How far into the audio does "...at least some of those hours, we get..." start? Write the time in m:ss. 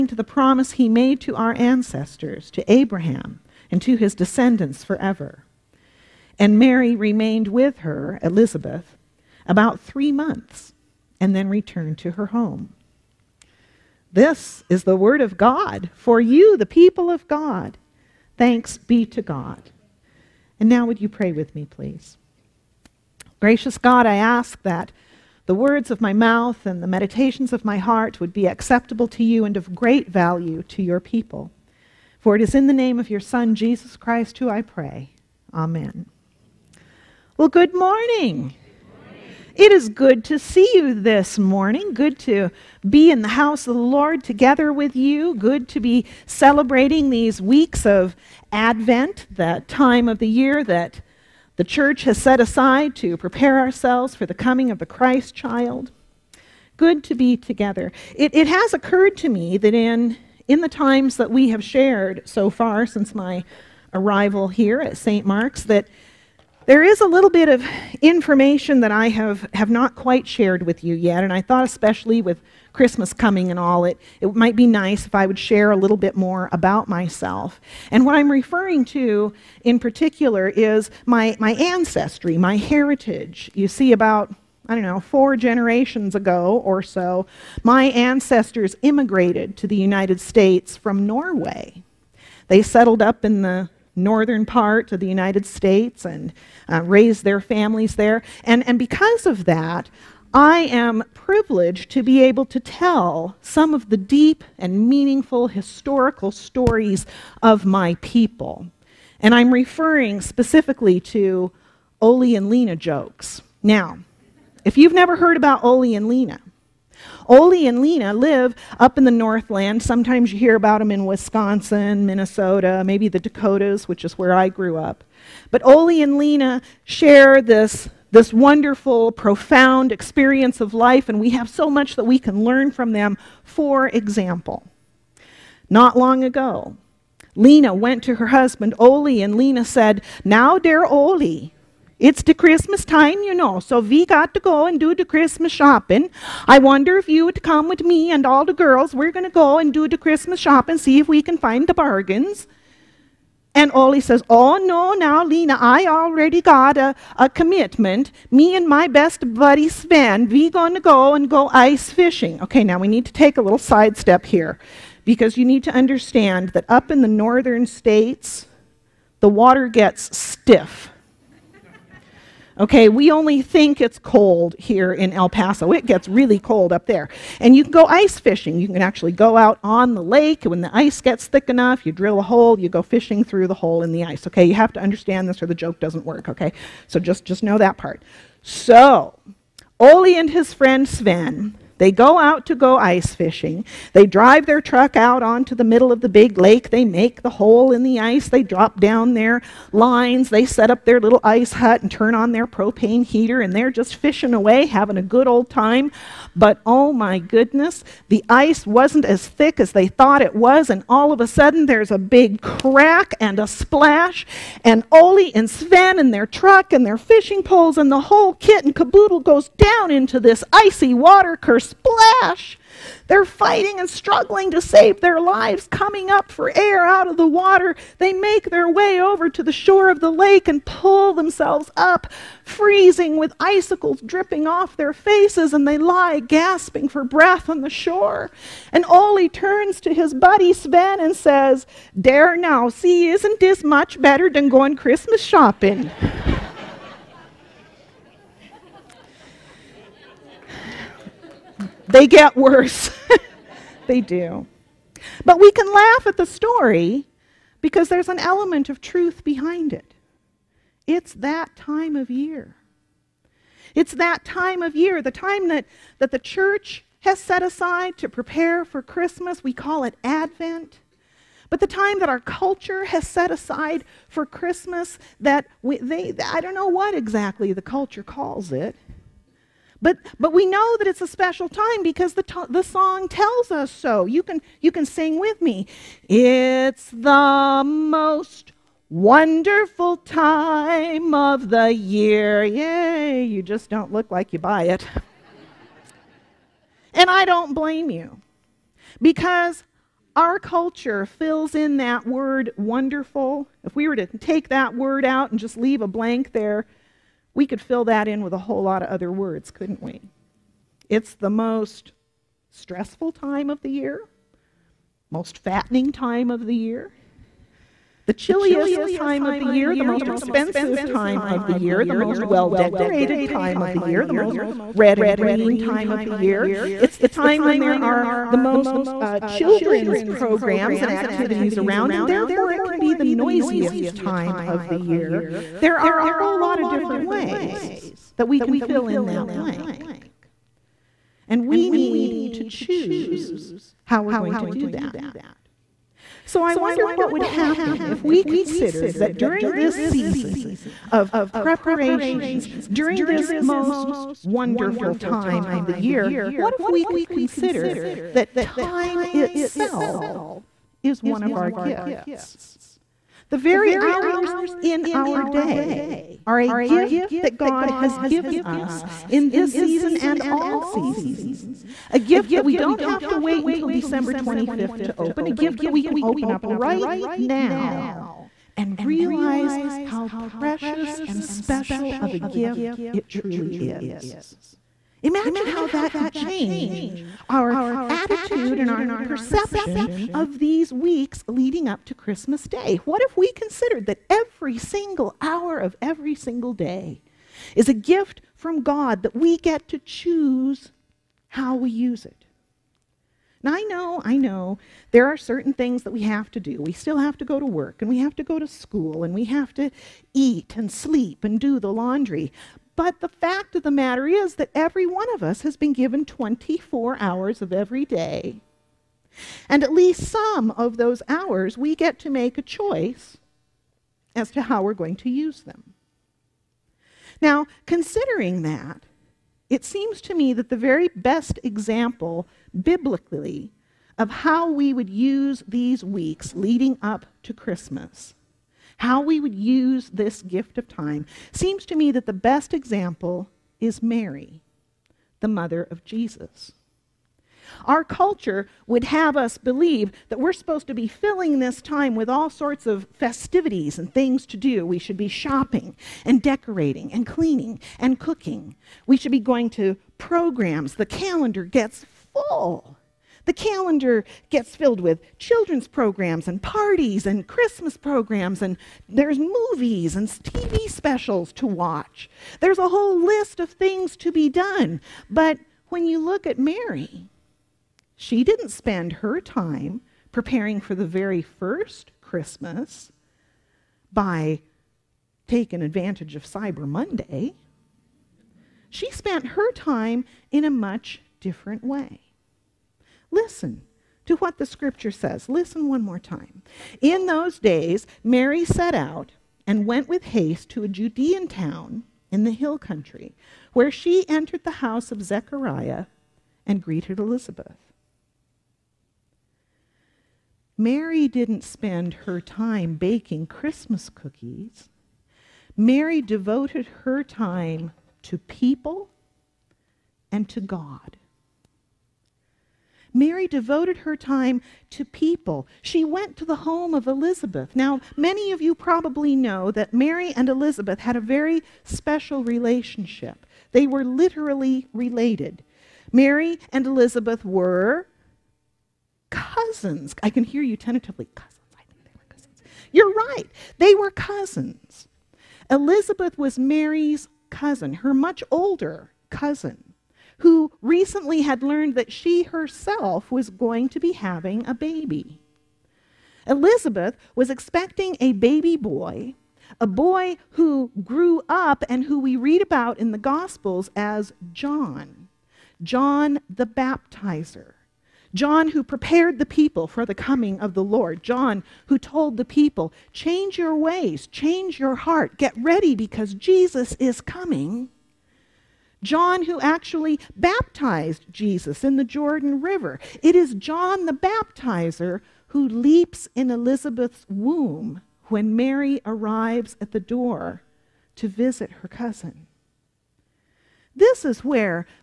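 6:59.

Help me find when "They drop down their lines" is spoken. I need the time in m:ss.
3:18.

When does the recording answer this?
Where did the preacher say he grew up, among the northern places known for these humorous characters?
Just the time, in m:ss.
2:03.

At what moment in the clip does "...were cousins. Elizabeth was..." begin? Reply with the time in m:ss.
9:03.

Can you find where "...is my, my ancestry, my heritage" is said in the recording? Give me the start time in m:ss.
1:20.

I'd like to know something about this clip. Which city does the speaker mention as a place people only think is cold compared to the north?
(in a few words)
El Paso.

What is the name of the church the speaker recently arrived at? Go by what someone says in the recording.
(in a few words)
St. Mark's.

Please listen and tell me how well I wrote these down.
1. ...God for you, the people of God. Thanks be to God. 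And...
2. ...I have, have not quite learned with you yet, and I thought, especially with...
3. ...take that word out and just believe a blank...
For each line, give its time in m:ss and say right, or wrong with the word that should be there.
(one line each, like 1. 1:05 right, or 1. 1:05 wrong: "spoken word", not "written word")
1. 0:15 right
2. 1:08 wrong: "shared", not "learned"
3. 5:04 wrong: "leave", not "believe".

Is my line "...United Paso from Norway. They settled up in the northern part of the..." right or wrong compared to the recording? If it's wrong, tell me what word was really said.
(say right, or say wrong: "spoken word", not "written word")
wrong: "States", not "Paso".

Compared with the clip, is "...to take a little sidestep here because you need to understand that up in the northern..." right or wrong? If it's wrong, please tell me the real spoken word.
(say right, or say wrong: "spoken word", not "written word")
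right.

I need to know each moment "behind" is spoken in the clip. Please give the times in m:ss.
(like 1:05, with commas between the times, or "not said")
4:19.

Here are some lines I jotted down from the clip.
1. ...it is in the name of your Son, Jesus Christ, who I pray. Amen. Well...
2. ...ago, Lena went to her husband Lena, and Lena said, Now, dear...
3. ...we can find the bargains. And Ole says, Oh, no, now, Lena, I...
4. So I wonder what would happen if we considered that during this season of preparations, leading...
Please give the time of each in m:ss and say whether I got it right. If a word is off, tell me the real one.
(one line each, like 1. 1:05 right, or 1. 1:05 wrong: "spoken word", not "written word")
1. 0:32 right
2. 2:16 wrong: "Ole", not "Lena"
3. 2:31 right
4. 5:46 wrong: "during", not "leading".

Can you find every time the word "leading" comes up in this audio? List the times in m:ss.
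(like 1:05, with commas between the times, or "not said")
6:31, 7:16.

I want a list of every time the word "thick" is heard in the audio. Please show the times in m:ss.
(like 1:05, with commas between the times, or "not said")
3:01, 3:29.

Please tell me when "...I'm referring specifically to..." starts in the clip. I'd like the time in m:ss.
1:49.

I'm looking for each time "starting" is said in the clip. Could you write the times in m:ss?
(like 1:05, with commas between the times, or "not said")
not said.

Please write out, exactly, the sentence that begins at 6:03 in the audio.
The very hours in our day are a gift that God has given us in this season and all seasons.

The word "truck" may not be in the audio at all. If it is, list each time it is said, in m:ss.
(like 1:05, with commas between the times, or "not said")
3:14, 3:36.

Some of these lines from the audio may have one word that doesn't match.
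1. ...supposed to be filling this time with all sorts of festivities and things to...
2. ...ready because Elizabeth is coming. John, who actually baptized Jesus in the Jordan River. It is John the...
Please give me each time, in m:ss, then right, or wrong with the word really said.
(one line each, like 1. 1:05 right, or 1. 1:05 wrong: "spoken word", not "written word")
1. 7:30 right
2. 9:35 wrong: "Jesus", not "Elizabeth".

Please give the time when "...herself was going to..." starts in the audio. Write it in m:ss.
9:12.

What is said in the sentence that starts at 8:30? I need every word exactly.
Mary didn't spend her time baking Christmas cookies.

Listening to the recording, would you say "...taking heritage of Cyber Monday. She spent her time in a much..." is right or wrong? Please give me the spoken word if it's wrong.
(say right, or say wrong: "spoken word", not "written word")
wrong: "advantage", not "heritage".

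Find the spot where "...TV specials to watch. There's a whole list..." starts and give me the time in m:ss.
7:50.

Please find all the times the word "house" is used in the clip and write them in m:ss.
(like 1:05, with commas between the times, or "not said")
0:43, 8:24.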